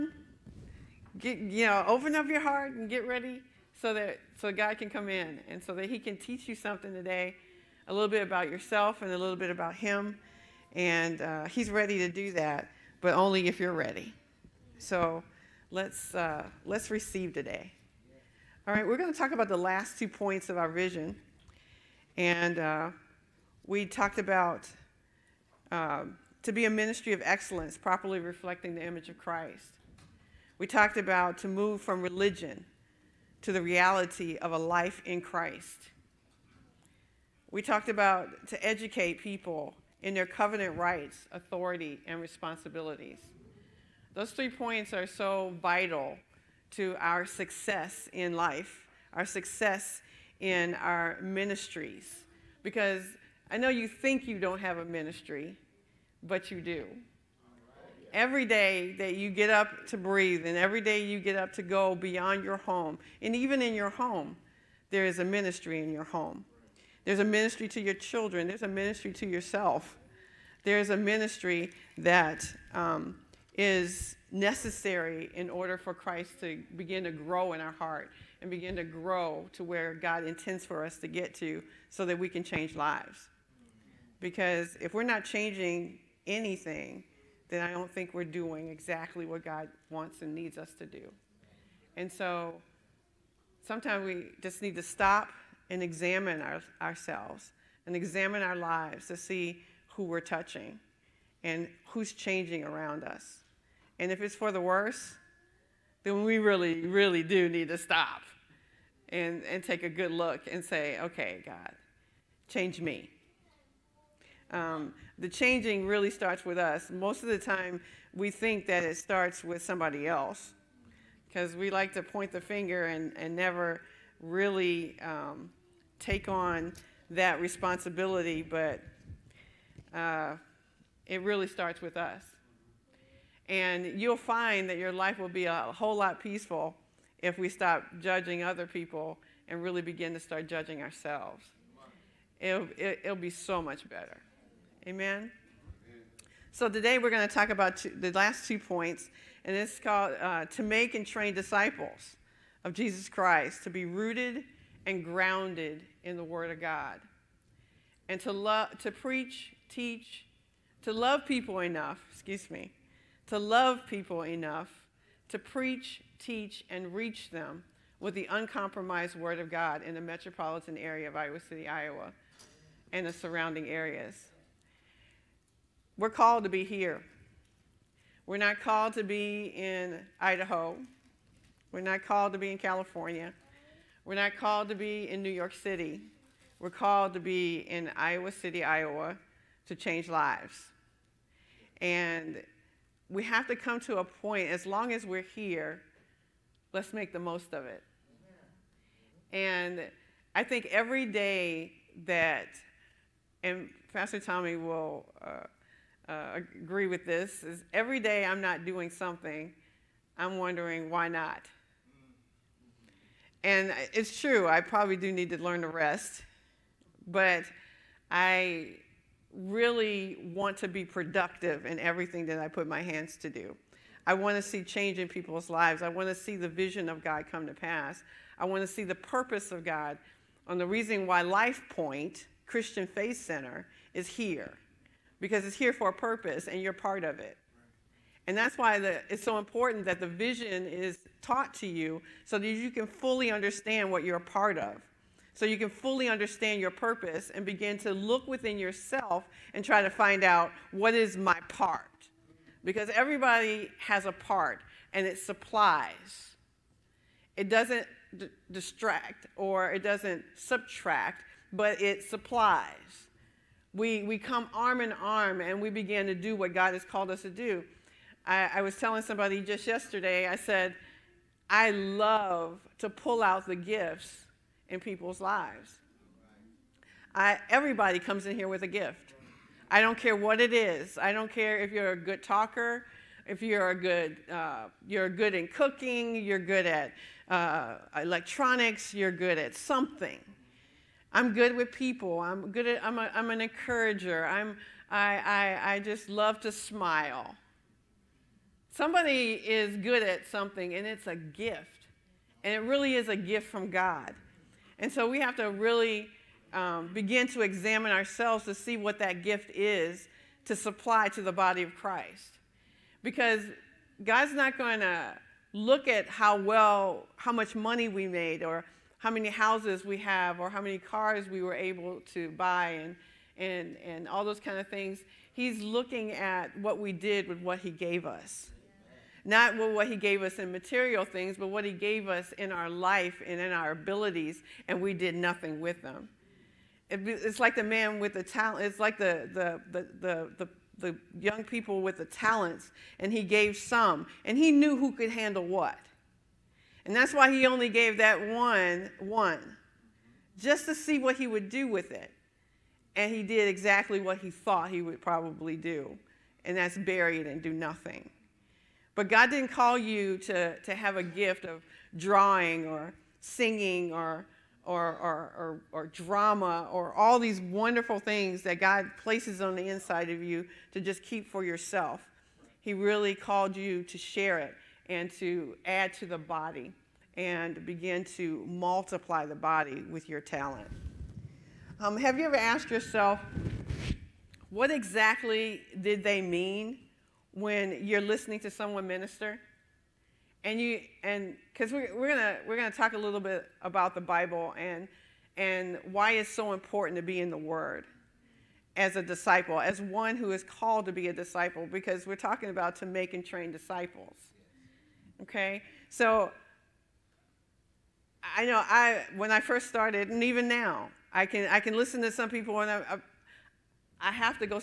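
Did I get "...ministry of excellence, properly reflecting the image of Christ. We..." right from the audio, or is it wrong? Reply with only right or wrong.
right.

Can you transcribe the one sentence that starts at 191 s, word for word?
And we have to come to a point, as long as we're here, let's make the most of it.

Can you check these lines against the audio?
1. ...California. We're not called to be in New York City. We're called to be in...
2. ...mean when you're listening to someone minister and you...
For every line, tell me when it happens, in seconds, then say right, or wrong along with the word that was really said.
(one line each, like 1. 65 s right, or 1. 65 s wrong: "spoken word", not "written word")
1. 182 s right
2. 386 s right.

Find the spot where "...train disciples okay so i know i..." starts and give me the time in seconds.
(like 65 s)
403 s.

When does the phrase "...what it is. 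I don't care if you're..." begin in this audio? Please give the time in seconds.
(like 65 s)
280 s.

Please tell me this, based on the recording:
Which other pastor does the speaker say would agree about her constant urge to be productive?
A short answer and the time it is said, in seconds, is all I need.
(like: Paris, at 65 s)
Pastor Tommy, at 203 s.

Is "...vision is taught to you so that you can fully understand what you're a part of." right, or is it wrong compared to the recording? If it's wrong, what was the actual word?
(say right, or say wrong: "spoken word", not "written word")
right.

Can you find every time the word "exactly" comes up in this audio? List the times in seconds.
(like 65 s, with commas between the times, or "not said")
88 s, 353 s, 384 s.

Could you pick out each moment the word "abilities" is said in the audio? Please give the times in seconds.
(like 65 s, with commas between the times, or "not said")
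333 s.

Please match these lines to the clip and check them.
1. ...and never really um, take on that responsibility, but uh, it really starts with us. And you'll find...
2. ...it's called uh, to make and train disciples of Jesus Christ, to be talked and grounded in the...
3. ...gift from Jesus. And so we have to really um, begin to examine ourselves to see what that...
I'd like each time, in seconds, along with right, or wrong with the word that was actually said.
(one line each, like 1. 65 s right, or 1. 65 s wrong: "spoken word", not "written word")
1. 123 s right
2. 149 s wrong: "rooted", not "talked"
3. 303 s wrong: "God", not "Jesus".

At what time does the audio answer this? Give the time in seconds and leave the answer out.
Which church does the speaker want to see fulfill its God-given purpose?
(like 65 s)
231 s.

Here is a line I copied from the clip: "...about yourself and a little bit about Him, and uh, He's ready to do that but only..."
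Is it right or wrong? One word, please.
right.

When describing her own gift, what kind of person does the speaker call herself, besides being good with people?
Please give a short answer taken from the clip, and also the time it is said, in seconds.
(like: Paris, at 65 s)
An encourager, at 293 s.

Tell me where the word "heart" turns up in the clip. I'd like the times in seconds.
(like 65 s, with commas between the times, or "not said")
2 s, 77 s.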